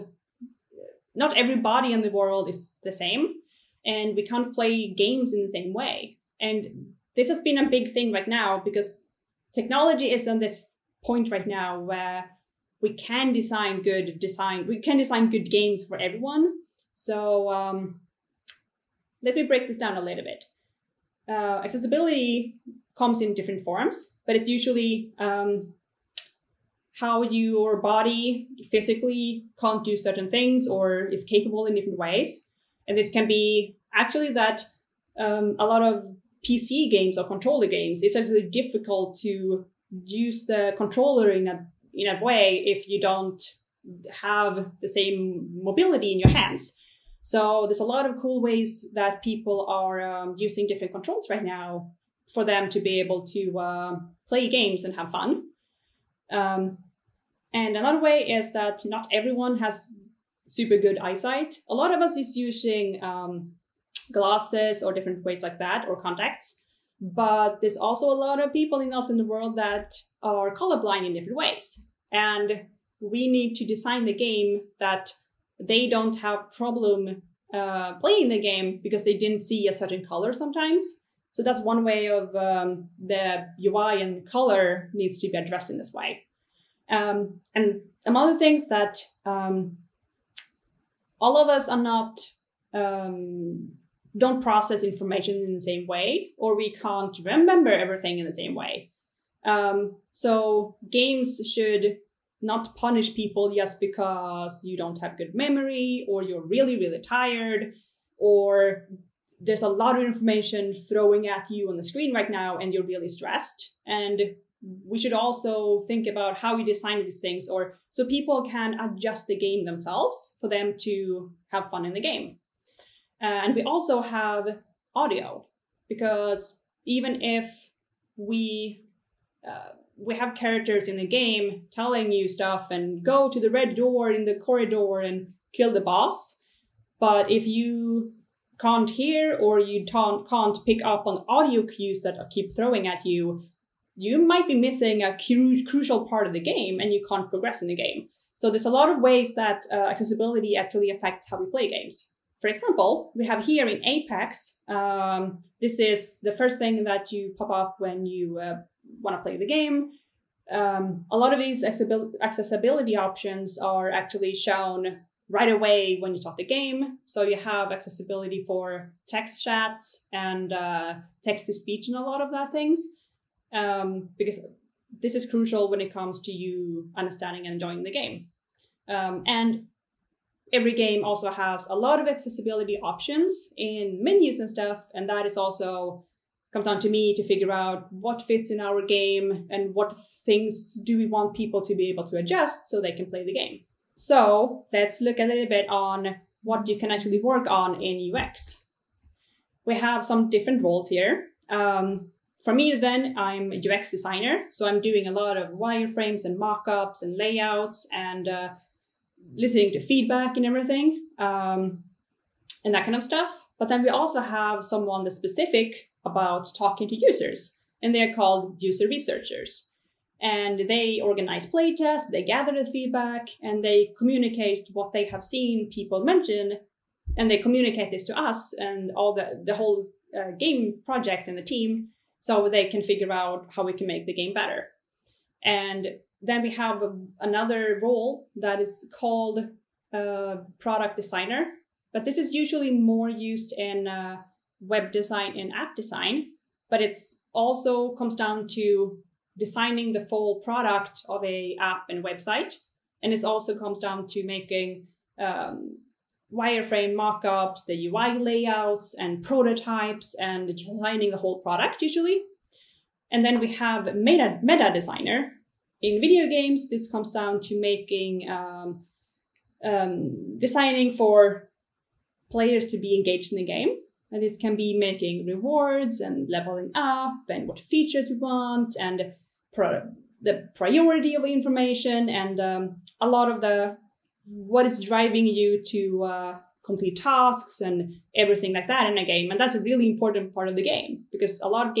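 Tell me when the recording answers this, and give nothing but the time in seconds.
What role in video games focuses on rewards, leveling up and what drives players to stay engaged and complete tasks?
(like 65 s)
264 s.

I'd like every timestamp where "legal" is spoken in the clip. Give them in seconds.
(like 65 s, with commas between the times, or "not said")
not said.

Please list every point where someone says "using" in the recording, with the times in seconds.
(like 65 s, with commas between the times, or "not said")
50 s, 62 s.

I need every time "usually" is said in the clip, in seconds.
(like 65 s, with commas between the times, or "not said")
24 s, 242 s, 261 s.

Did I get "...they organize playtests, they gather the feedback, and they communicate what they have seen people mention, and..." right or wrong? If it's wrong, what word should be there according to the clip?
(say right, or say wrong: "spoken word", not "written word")
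right.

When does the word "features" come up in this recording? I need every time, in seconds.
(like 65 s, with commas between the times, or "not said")
277 s.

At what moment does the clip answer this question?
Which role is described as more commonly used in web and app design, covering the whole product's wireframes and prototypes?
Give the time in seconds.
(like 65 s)
240 s.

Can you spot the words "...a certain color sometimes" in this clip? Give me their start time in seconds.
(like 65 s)
79 s.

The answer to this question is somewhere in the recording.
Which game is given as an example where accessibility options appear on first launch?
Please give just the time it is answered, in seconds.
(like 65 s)
153 s.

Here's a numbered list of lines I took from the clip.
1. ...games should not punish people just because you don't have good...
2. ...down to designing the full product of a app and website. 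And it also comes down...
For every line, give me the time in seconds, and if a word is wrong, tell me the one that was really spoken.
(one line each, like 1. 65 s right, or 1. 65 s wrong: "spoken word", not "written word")
1. 100 s right
2. 248 s right.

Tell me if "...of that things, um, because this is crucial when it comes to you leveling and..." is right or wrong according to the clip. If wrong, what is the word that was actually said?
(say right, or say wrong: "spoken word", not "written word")
wrong: "understanding", not "leveling".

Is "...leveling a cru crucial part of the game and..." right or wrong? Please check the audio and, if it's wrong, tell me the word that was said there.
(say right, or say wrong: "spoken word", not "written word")
wrong: "missing", not "leveling".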